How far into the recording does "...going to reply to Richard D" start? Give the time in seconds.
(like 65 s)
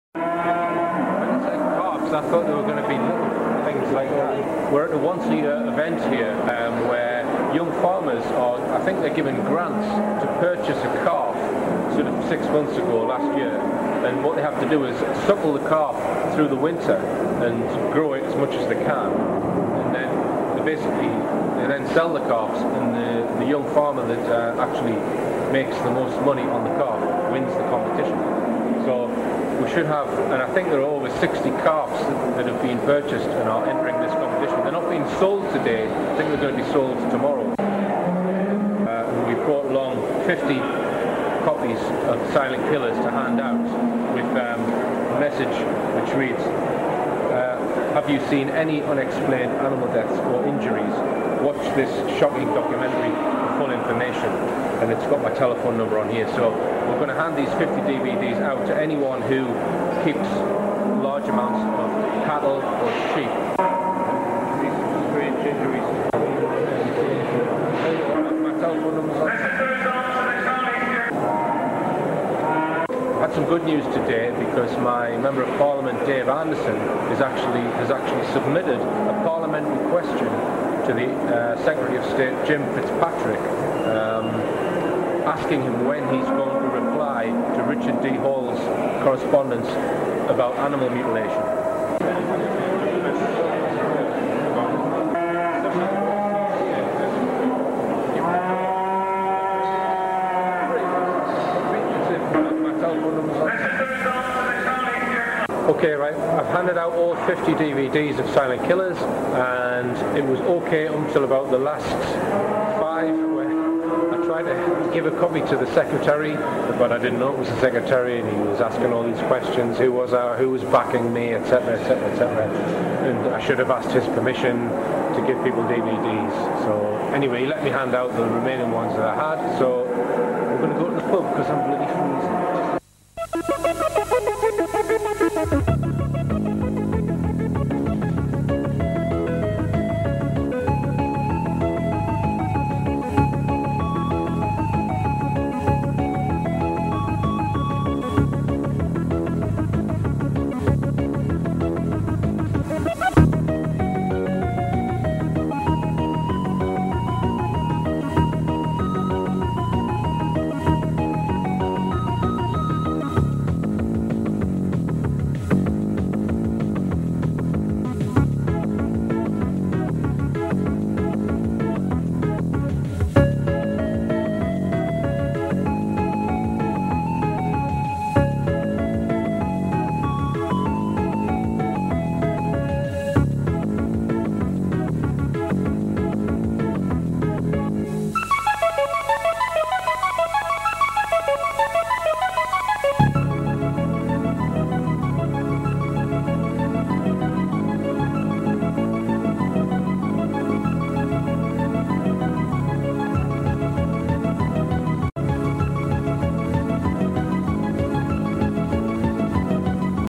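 86 s.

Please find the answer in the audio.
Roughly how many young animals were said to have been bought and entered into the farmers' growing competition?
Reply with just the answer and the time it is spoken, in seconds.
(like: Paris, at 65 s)
over 60, at 30 s.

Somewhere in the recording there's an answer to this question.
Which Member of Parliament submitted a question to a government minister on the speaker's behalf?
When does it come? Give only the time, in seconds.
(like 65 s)
76 s.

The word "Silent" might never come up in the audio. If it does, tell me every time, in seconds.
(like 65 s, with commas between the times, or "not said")
42 s, 108 s.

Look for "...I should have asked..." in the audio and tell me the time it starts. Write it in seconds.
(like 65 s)
123 s.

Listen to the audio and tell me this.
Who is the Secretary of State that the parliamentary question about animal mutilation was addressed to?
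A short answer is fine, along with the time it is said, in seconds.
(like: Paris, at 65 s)
Jim Fitzpatrick, at 82 s.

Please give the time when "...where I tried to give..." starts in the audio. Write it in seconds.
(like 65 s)
113 s.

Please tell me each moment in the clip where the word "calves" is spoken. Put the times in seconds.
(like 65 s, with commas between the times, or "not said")
22 s, 31 s.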